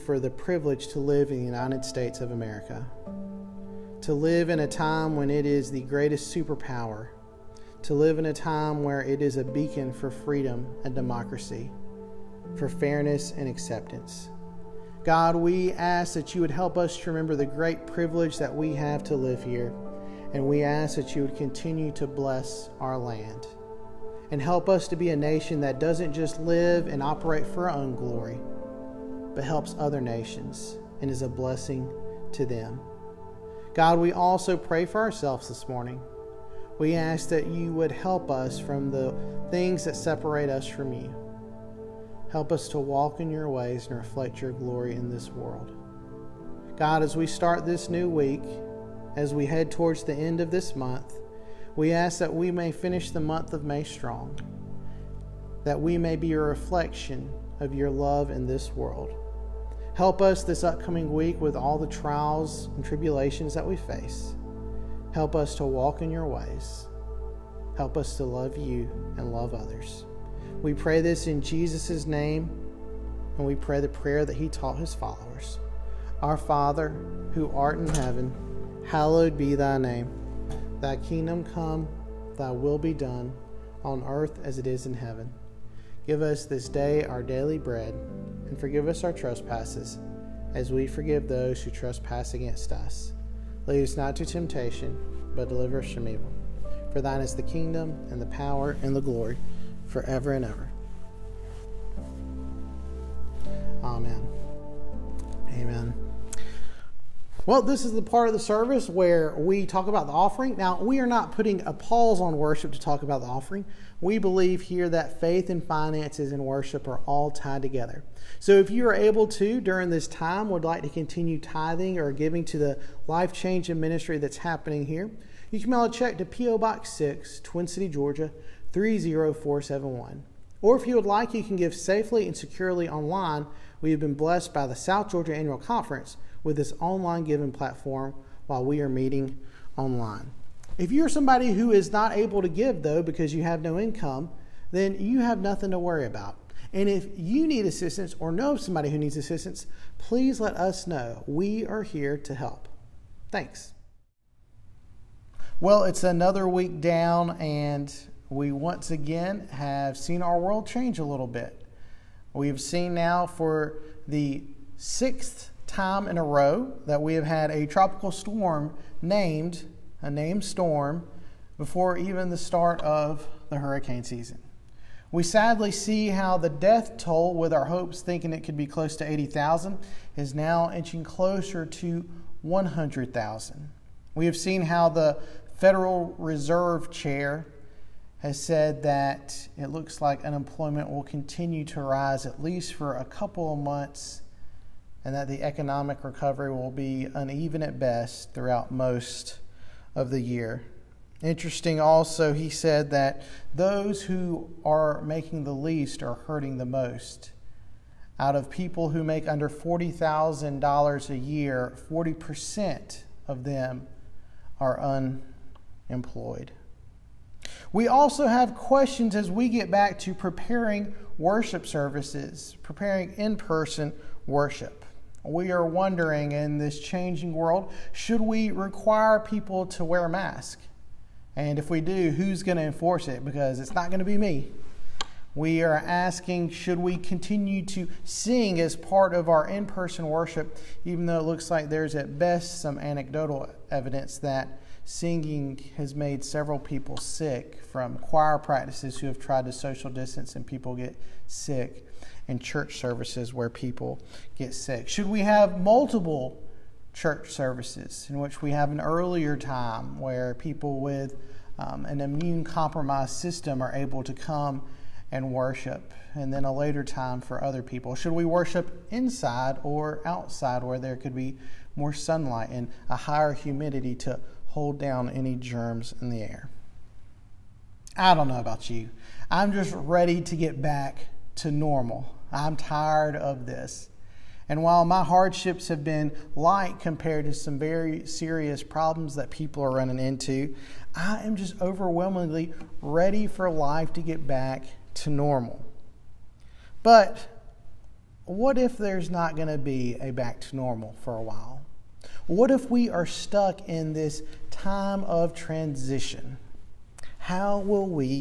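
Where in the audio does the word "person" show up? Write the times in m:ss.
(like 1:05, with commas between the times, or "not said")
3:43, 3:59.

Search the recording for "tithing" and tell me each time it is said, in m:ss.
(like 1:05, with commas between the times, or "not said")
2:01.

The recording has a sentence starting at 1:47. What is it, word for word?
Well, this is the part of the service where we talk about the offering.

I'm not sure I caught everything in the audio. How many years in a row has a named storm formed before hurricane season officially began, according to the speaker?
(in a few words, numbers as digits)
sixth.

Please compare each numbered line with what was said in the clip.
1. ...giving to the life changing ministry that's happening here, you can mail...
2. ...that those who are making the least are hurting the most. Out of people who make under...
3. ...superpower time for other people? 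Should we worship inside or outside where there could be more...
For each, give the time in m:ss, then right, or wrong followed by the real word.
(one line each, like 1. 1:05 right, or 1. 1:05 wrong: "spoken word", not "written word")
1. 2:02 right
2. 3:22 right
3. 4:26 wrong: "later", not "superpower".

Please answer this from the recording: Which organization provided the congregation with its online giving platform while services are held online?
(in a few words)
South Georgia Annual Conference.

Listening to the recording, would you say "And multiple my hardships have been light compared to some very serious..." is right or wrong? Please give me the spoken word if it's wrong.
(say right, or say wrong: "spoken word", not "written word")
wrong: "while", not "multiple".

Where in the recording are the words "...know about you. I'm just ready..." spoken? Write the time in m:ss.
4:38.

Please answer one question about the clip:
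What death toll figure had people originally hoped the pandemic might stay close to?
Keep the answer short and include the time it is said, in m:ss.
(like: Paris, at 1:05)
80,000, at 2:59.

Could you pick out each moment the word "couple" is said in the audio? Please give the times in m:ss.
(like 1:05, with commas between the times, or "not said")
3:13.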